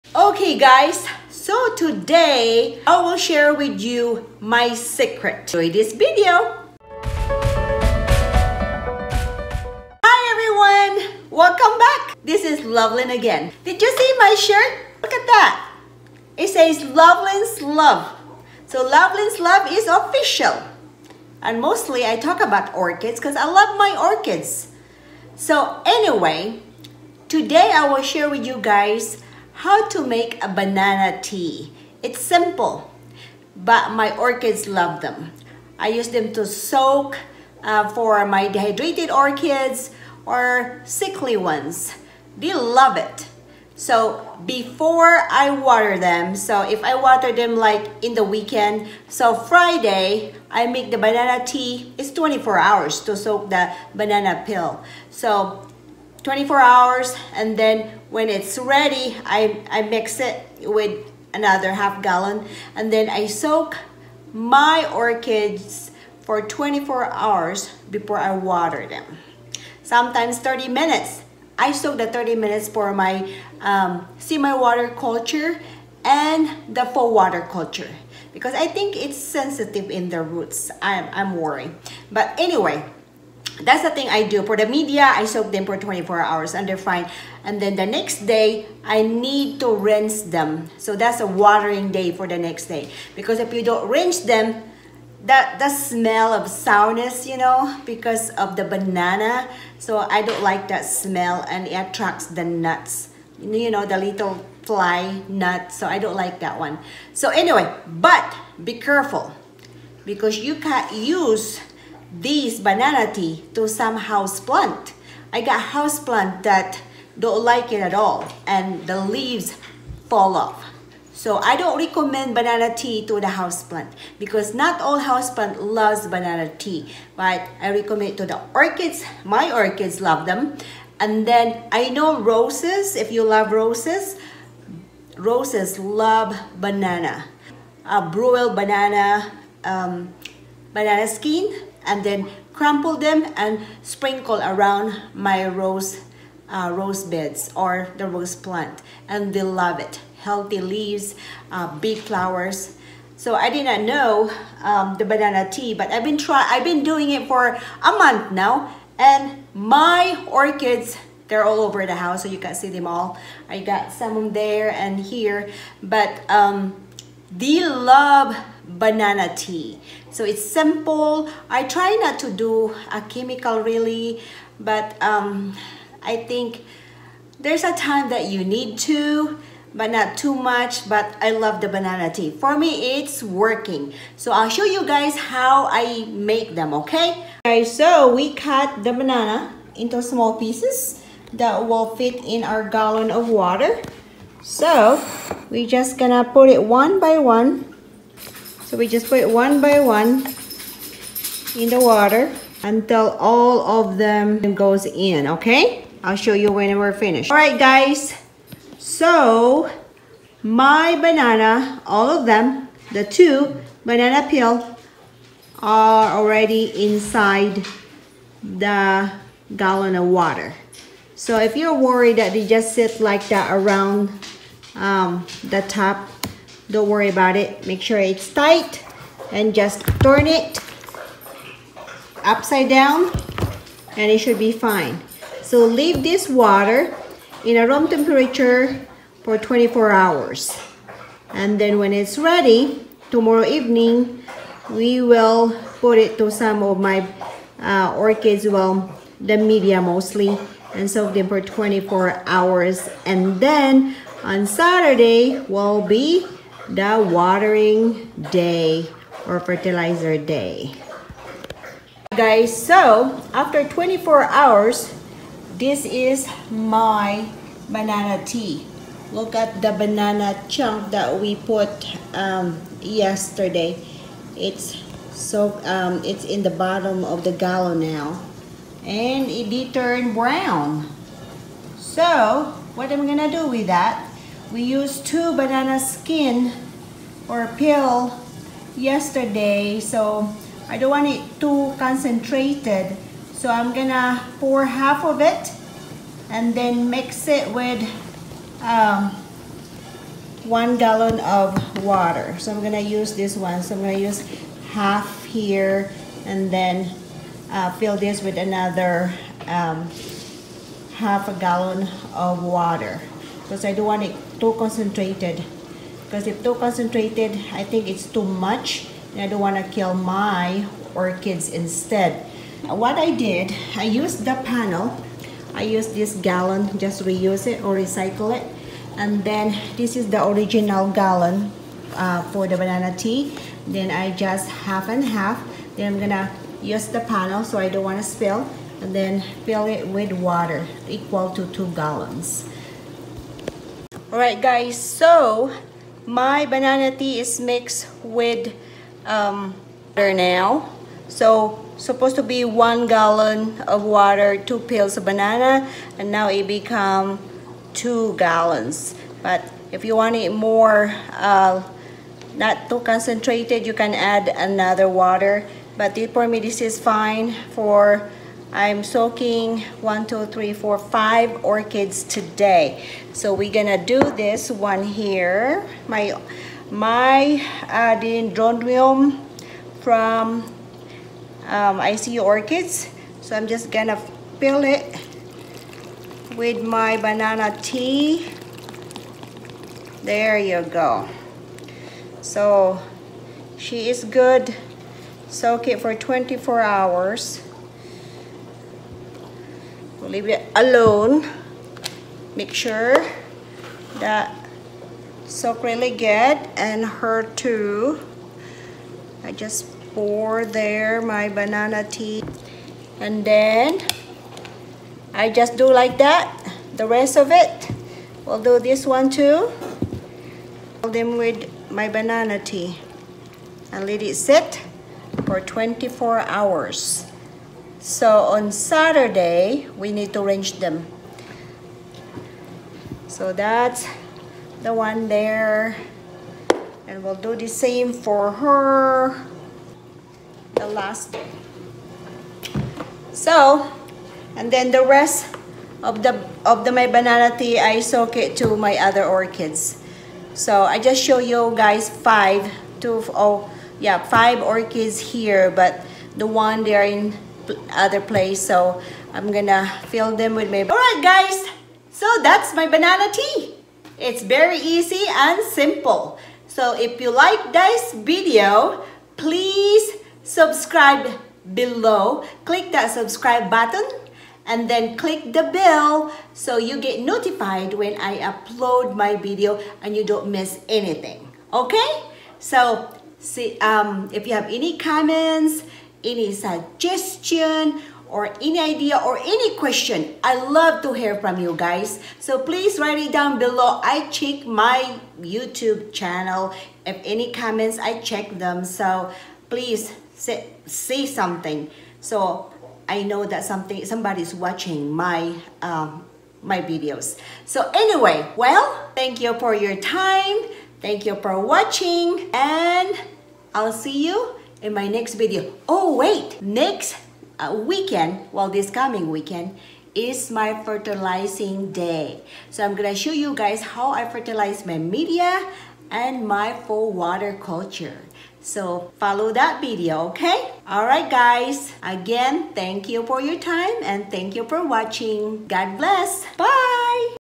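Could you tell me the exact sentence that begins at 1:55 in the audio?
I got houseplant that don't like it at all and the leaves fall off.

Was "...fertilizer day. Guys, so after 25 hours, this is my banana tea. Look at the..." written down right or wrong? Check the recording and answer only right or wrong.
wrong.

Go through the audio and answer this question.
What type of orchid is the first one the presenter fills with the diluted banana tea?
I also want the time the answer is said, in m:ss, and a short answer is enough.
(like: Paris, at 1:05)
Dendrobium, at 6:17.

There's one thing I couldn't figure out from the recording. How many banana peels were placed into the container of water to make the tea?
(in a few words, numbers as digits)
2.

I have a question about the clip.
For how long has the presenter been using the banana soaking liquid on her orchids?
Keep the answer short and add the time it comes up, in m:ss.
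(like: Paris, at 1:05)
A month, at 2:37.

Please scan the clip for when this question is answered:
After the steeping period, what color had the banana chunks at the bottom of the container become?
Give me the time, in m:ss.
4:39.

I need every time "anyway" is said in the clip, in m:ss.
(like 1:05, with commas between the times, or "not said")
0:25, 1:22, 1:47, 8:27.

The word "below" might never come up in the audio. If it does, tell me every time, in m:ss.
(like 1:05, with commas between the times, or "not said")
7:51, 8:13.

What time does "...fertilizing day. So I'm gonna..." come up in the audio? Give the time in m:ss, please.
8:40.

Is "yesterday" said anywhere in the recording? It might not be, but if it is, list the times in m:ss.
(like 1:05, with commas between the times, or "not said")
4:32, 4:48.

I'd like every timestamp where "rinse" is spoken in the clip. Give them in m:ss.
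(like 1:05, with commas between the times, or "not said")
1:29, 1:33.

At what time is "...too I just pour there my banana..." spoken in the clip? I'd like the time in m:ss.
6:47.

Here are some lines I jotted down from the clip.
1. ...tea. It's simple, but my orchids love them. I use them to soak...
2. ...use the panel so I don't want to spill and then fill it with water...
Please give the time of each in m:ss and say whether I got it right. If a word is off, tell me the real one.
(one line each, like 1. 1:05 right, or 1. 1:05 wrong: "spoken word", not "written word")
1. 0:31 right
2. 5:36 right.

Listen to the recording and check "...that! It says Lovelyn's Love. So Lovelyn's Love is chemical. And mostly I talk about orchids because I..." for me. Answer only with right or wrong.
wrong.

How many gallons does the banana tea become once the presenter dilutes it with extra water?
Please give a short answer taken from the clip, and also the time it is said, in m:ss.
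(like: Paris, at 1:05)
2, at 5:56.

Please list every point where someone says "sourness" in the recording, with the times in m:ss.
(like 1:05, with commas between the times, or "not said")
1:36.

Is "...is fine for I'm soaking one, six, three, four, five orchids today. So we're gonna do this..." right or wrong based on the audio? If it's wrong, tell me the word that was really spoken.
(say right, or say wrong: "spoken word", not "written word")
wrong: "two", not "six".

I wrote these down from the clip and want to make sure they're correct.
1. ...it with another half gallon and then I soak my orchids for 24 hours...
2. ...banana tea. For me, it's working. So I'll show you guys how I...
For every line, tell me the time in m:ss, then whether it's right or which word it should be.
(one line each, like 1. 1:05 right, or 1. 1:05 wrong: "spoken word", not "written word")
1. 1:00 right
2. 3:01 right.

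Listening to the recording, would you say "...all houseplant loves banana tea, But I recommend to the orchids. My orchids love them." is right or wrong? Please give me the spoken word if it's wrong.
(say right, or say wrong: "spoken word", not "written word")
right.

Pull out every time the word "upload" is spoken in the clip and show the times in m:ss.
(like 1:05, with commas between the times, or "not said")
7:58.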